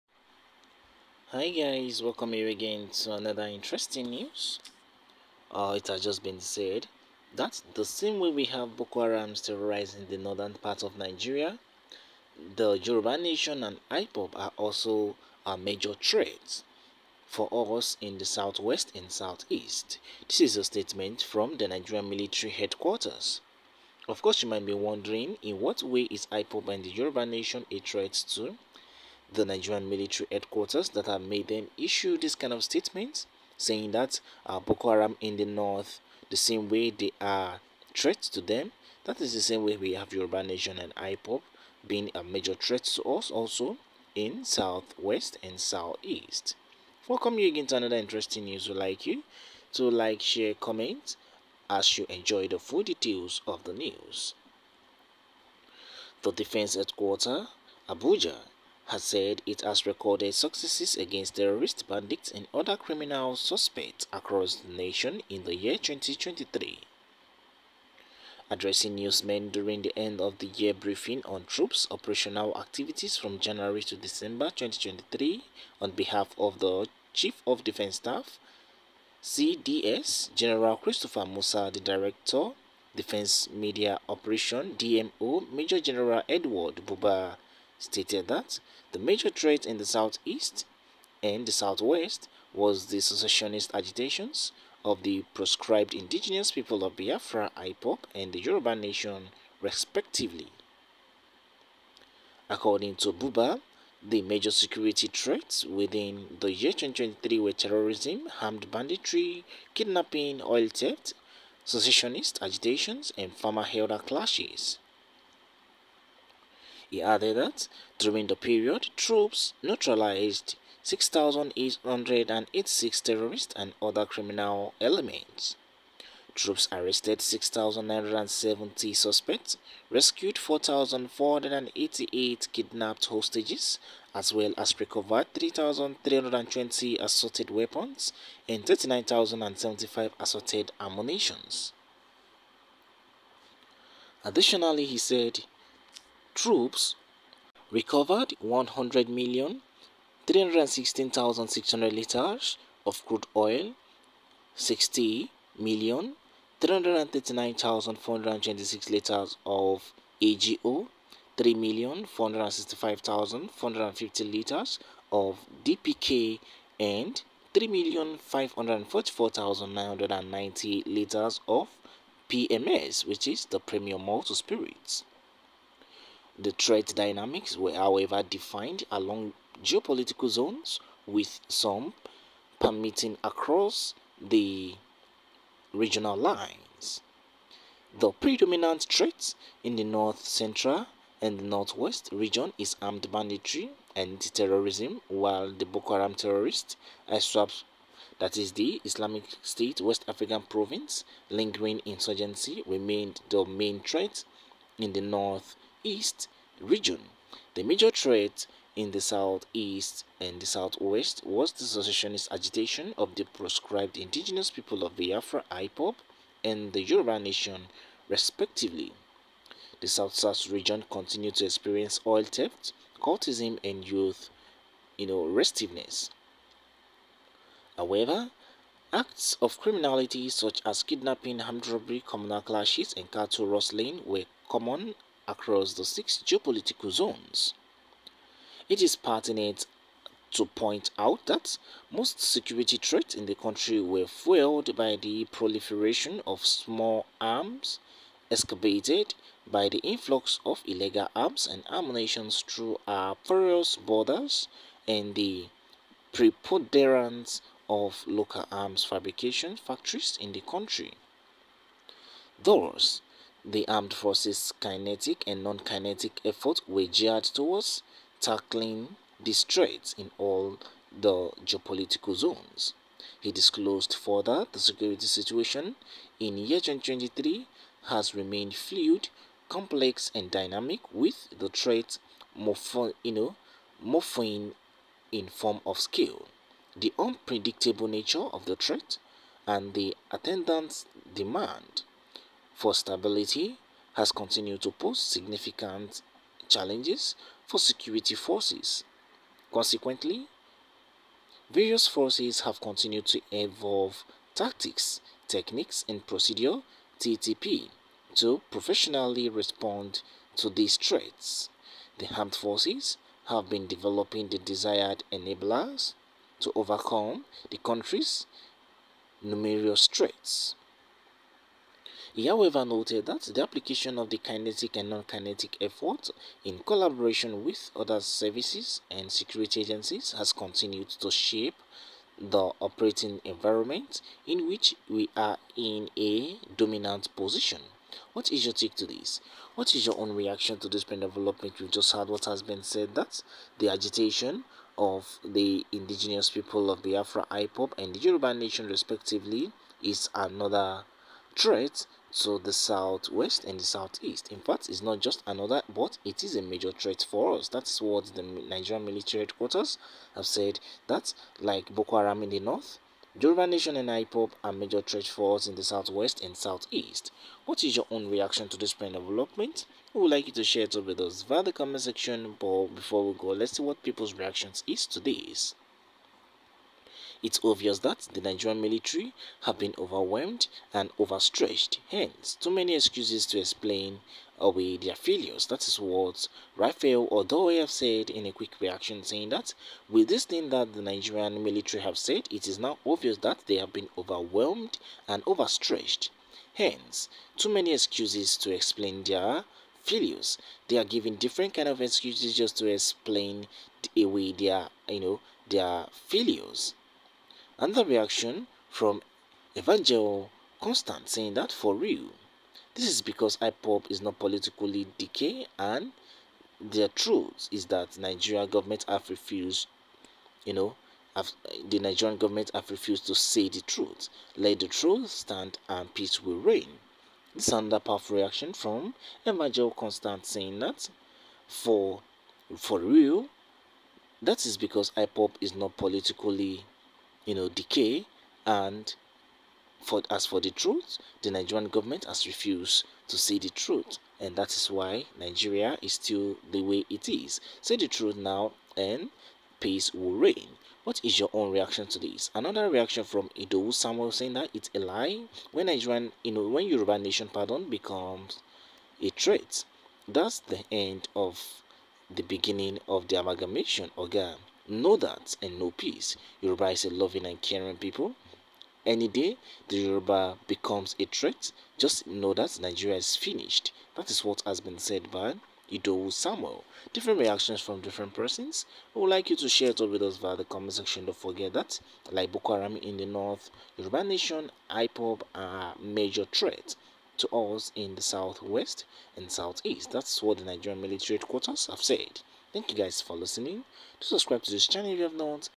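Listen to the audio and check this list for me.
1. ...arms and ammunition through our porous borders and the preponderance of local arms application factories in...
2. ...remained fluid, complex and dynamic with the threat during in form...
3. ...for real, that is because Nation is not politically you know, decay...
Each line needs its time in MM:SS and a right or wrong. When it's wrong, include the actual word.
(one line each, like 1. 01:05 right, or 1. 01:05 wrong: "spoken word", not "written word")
1. 04:11 wrong: "fabrication", not "application"
2. 04:38 wrong: "morphing", not "during"
3. 07:12 wrong: "IPOB", not "Nation".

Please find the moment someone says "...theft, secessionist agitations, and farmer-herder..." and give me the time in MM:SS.
01:50.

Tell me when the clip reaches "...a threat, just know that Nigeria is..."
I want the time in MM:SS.
07:50.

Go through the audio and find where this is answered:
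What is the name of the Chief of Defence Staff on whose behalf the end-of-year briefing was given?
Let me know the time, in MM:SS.
01:20.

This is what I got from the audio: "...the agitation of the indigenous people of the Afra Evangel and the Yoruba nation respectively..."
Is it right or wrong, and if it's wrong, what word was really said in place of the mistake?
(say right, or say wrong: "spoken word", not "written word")
wrong: "IPOB", not "Evangel".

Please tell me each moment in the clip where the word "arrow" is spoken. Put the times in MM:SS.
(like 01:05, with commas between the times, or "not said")
not said.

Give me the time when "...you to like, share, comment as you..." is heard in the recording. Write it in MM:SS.
00:49.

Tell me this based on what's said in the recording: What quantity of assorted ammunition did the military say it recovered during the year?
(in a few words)
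39,075.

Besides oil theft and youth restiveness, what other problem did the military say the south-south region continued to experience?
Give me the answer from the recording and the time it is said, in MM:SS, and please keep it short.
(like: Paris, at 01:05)
Cultism, at 03:43.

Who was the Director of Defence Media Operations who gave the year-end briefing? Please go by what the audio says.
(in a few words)
Major General Edward Buba.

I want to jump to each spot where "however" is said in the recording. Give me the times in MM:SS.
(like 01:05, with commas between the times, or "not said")
02:57, 03:47, 05:22.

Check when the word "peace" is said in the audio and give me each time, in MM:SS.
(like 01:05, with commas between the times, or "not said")
07:05, 07:29, 07:45.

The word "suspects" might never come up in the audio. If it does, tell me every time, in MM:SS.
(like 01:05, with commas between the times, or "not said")
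01:03, 02:08.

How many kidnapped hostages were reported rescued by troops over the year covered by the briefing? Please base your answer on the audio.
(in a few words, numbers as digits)
4,488.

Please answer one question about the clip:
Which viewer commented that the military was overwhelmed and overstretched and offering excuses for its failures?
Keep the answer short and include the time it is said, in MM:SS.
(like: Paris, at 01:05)
Rafael Odoye, at 06:26.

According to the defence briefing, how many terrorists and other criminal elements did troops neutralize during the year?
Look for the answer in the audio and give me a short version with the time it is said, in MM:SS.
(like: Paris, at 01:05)
6,886, at 02:00.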